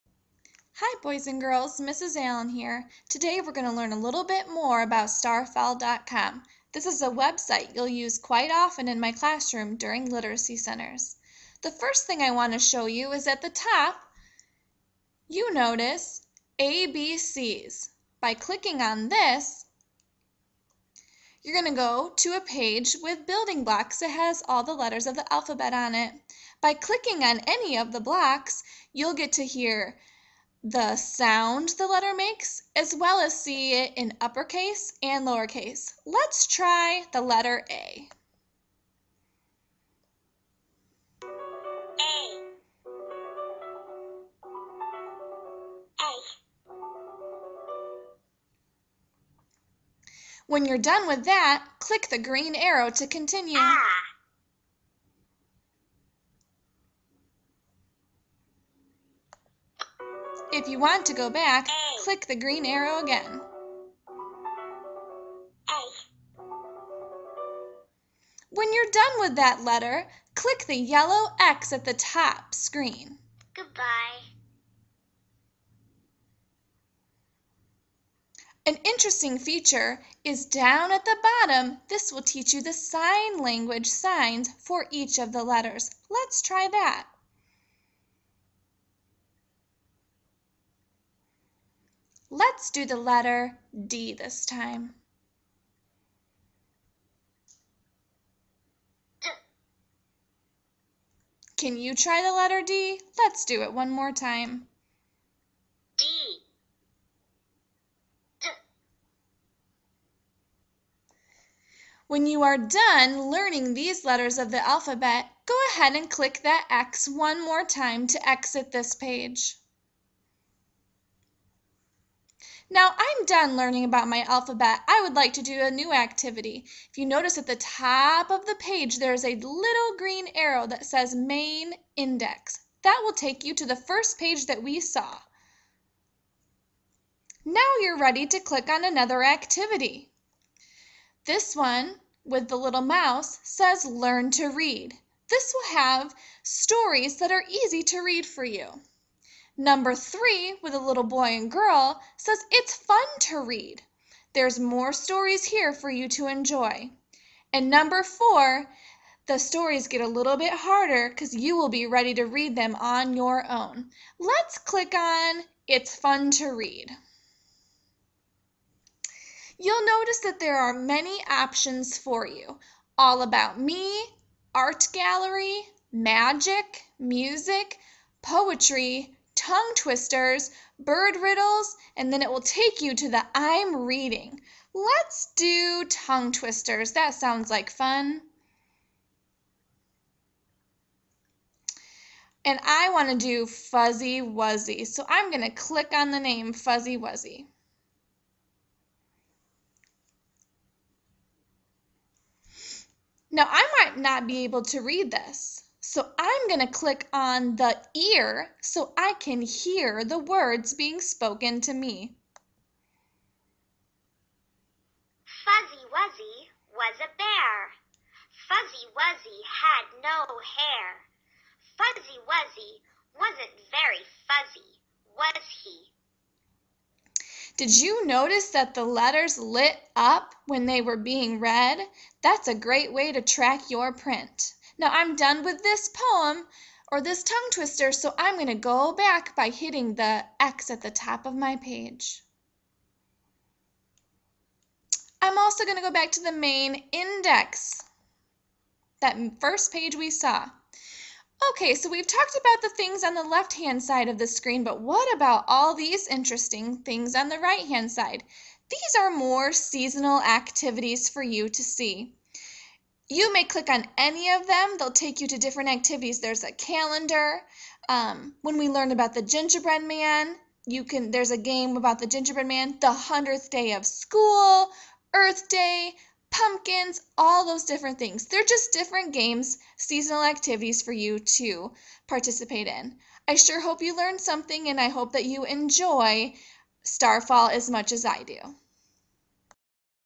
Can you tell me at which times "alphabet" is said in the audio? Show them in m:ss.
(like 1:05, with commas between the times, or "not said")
0:25, 1:54, 2:04.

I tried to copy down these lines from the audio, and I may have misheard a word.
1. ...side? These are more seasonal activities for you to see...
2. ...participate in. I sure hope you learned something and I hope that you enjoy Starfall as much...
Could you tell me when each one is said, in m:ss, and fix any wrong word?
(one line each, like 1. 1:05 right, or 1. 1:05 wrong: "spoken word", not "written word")
1. 4:17 right
2. 4:42 right.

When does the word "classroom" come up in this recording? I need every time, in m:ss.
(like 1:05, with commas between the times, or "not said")
0:09.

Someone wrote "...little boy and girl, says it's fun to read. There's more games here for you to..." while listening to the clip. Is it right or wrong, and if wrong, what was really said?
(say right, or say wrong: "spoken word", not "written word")
wrong: "stories", not "games".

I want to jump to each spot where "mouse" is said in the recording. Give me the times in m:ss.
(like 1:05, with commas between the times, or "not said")
2:22.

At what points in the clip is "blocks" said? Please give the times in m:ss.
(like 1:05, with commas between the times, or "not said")
0:23, 0:28.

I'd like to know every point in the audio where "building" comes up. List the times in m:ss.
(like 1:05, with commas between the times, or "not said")
0:23.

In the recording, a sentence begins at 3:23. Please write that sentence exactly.
Now I might not be able to read this.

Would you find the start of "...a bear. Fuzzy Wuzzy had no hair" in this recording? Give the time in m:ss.
3:36.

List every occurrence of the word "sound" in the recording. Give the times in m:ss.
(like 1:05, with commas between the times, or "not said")
0:30, 3:07.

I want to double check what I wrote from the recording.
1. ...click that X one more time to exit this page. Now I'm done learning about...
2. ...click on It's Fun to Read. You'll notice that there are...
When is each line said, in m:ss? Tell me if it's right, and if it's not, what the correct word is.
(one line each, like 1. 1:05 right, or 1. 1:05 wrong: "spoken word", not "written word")
1. 1:56 right
2. 2:44 right.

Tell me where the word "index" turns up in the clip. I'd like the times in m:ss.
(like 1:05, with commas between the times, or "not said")
2:11, 4:06.